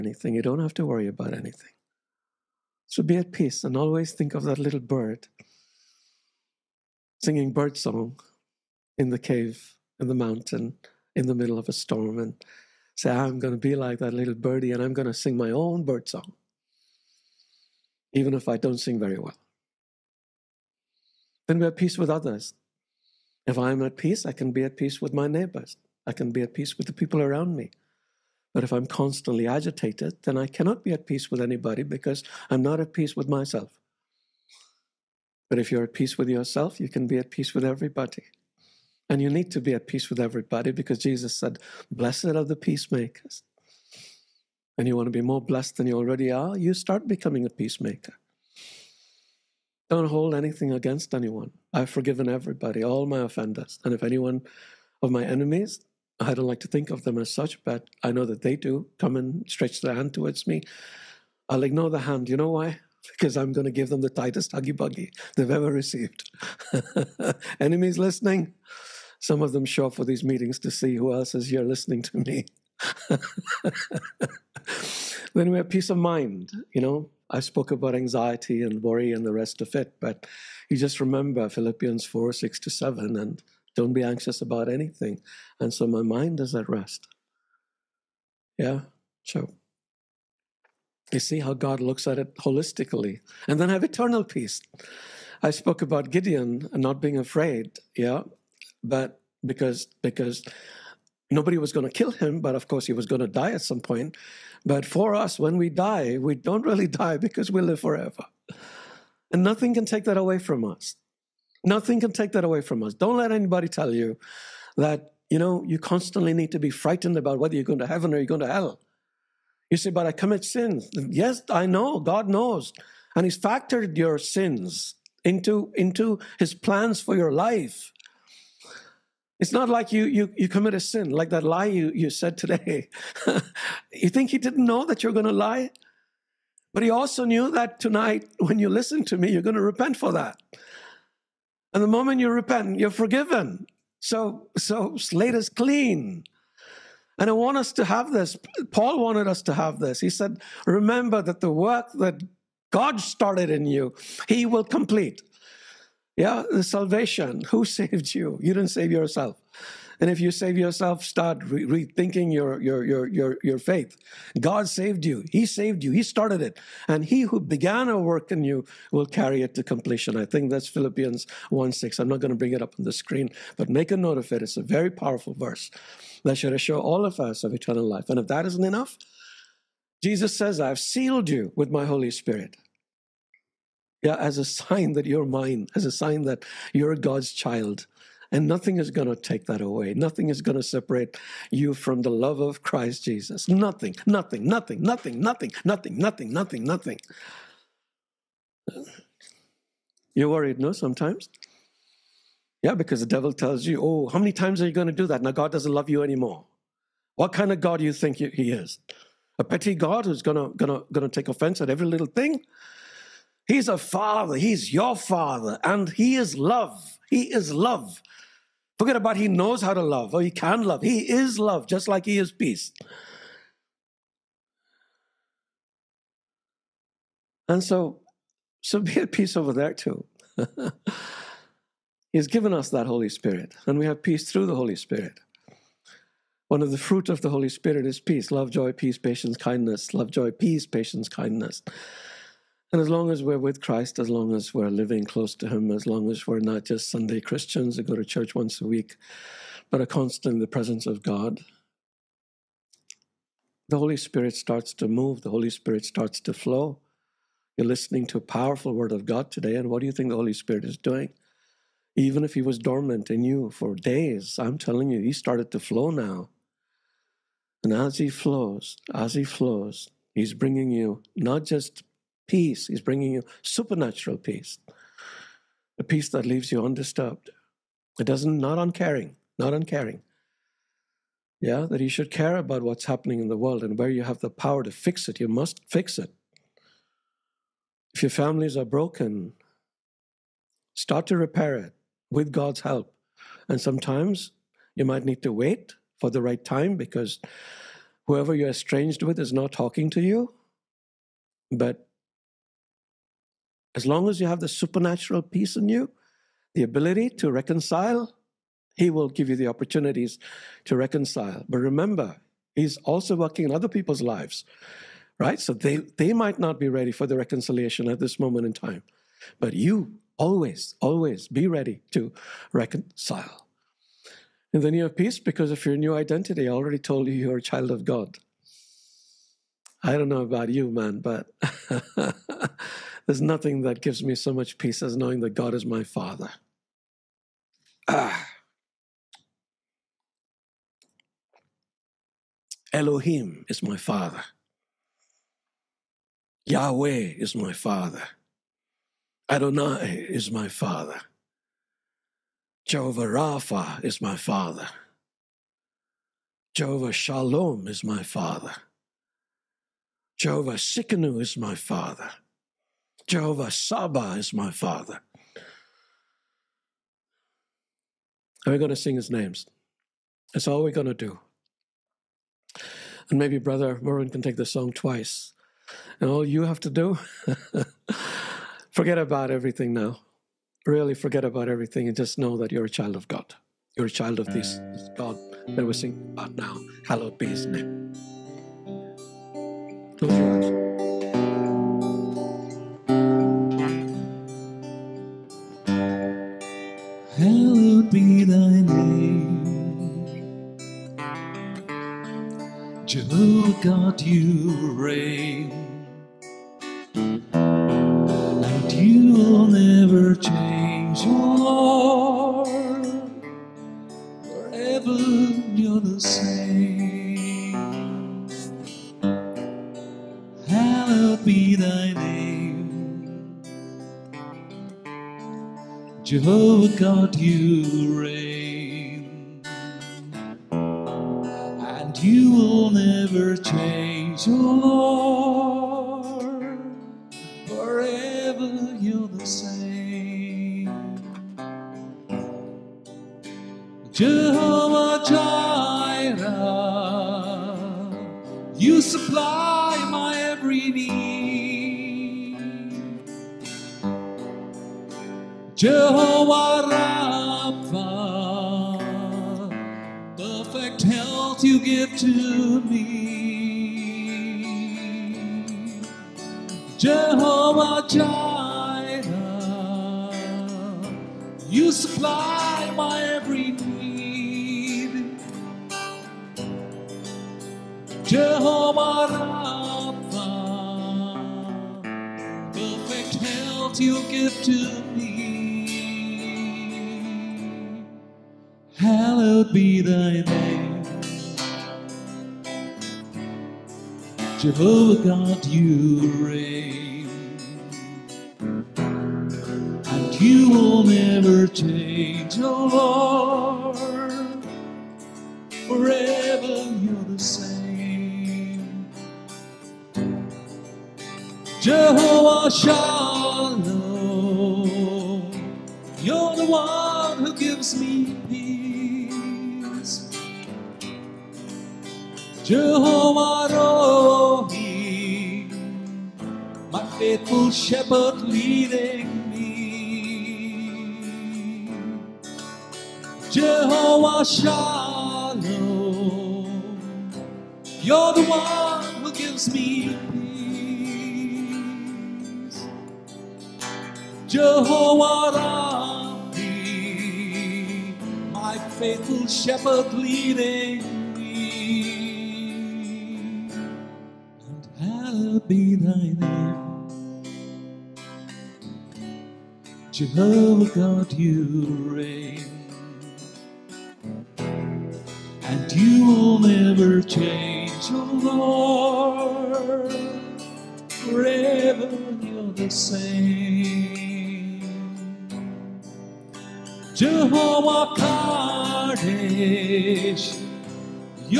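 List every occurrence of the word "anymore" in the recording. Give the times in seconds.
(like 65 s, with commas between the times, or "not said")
206 s.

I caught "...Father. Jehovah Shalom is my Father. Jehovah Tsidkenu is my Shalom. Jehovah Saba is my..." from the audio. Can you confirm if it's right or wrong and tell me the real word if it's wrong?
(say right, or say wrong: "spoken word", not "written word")
wrong: "Father", not "Shalom".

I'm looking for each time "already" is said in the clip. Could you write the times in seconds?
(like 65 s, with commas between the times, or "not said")
45 s, 326 s.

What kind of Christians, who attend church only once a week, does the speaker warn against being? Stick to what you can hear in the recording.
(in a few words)
Sunday Christians.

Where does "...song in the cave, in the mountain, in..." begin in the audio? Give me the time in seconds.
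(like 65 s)
7 s.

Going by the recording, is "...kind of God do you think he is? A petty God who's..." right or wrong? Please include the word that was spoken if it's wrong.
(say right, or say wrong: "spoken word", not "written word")
right.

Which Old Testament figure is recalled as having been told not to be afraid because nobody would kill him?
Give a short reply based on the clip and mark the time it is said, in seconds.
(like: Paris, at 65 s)
Gideon, at 96 s.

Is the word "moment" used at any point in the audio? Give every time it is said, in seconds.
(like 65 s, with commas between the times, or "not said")
141 s, 318 s.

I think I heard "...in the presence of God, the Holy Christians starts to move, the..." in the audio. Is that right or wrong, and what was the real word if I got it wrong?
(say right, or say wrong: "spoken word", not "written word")
wrong: "Spirit", not "Christians".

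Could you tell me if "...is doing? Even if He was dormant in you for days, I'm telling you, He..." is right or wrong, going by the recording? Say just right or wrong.
right.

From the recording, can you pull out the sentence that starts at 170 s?
I think that's Philippians 1 6.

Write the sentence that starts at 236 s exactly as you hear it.
One of the fruit of the Holy Spirit is peace, love, joy, peace, patience, kindness, love, joy, peace, patience, kindness.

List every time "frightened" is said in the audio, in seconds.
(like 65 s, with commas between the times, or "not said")
116 s.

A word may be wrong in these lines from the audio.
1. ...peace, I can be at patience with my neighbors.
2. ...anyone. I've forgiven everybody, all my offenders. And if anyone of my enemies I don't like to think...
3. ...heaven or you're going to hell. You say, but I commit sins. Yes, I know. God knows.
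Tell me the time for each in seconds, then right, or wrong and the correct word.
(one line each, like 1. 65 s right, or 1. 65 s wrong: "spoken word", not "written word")
1. 23 s wrong: "peace", not "patience"
2. 51 s right
3. 117 s right.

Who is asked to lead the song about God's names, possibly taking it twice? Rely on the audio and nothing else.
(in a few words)
Brother Merwin.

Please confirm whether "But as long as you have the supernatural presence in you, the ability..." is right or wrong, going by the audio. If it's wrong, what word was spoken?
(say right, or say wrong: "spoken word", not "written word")
wrong: "peace", not "presence".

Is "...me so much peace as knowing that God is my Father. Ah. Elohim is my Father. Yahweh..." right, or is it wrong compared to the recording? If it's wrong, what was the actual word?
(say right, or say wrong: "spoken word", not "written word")
right.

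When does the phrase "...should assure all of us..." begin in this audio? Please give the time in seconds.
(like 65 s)
176 s.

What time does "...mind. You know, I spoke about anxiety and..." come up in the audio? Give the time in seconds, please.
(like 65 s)
75 s.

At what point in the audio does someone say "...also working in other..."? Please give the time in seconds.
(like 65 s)
312 s.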